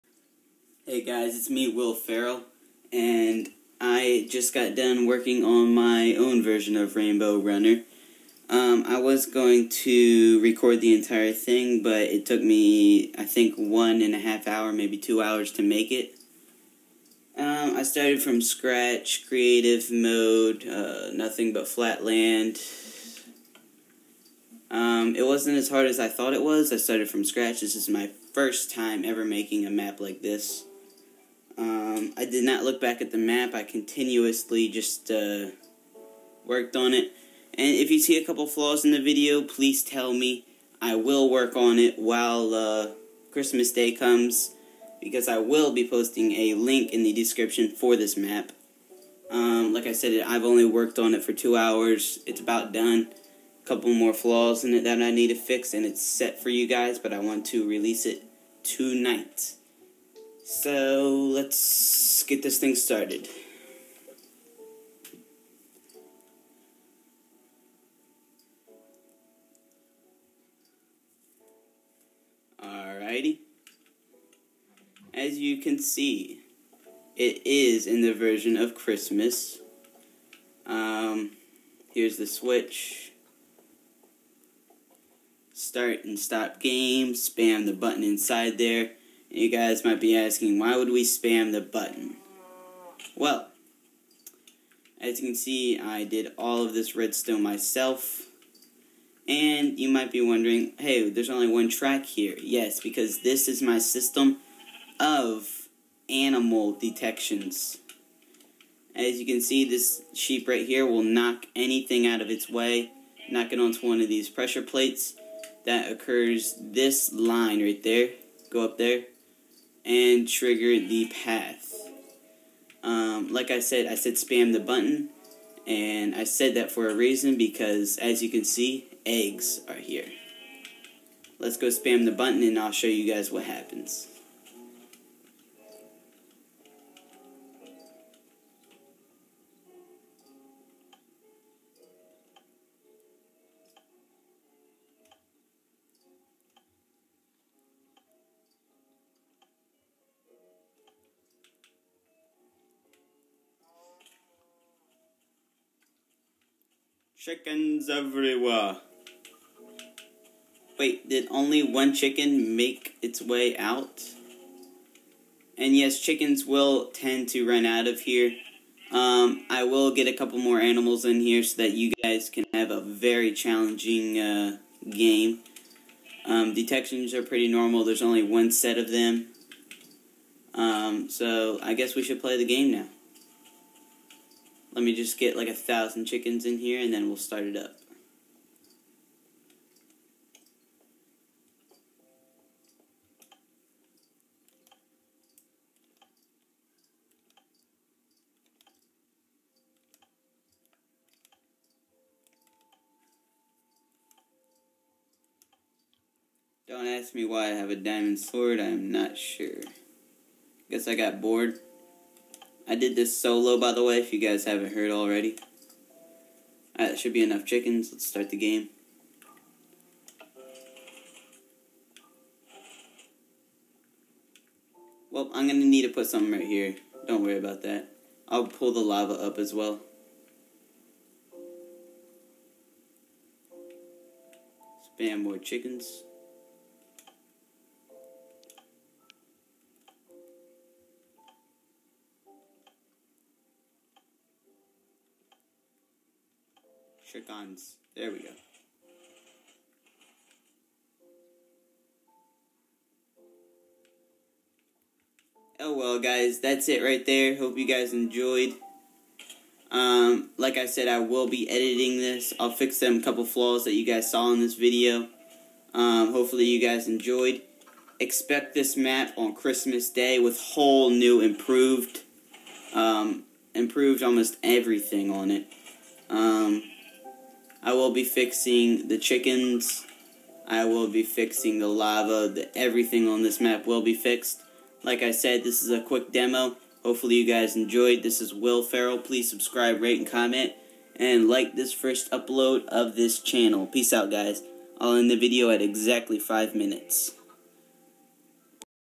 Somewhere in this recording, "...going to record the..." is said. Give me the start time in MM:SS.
00:09.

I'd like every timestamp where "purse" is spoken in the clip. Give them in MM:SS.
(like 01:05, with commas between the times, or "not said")
not said.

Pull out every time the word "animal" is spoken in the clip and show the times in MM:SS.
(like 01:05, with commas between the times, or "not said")
01:46, 02:50.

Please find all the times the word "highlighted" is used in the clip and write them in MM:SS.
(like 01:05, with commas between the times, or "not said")
not said.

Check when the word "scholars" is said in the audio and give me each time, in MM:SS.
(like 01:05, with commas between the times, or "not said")
not said.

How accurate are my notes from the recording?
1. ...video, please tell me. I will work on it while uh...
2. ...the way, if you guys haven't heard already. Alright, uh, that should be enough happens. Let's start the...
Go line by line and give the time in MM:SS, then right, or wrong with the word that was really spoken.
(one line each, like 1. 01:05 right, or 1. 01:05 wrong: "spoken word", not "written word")
1. 00:39 right
2. 03:33 wrong: "chickens", not "happens".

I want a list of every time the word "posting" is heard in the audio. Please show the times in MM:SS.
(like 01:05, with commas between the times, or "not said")
00:45.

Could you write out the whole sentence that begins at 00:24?
Um, it wasn't as hard as I thought it was.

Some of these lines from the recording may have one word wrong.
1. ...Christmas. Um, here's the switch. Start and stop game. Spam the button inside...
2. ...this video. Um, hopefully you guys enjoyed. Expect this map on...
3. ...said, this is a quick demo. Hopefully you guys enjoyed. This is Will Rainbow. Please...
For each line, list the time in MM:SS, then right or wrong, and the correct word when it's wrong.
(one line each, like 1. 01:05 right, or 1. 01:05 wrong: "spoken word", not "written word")
1. 01:18 right
2. 04:24 right
3. 04:45 wrong: "Ferrell", not "Rainbow".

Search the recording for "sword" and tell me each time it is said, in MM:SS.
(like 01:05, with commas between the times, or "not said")
03:28.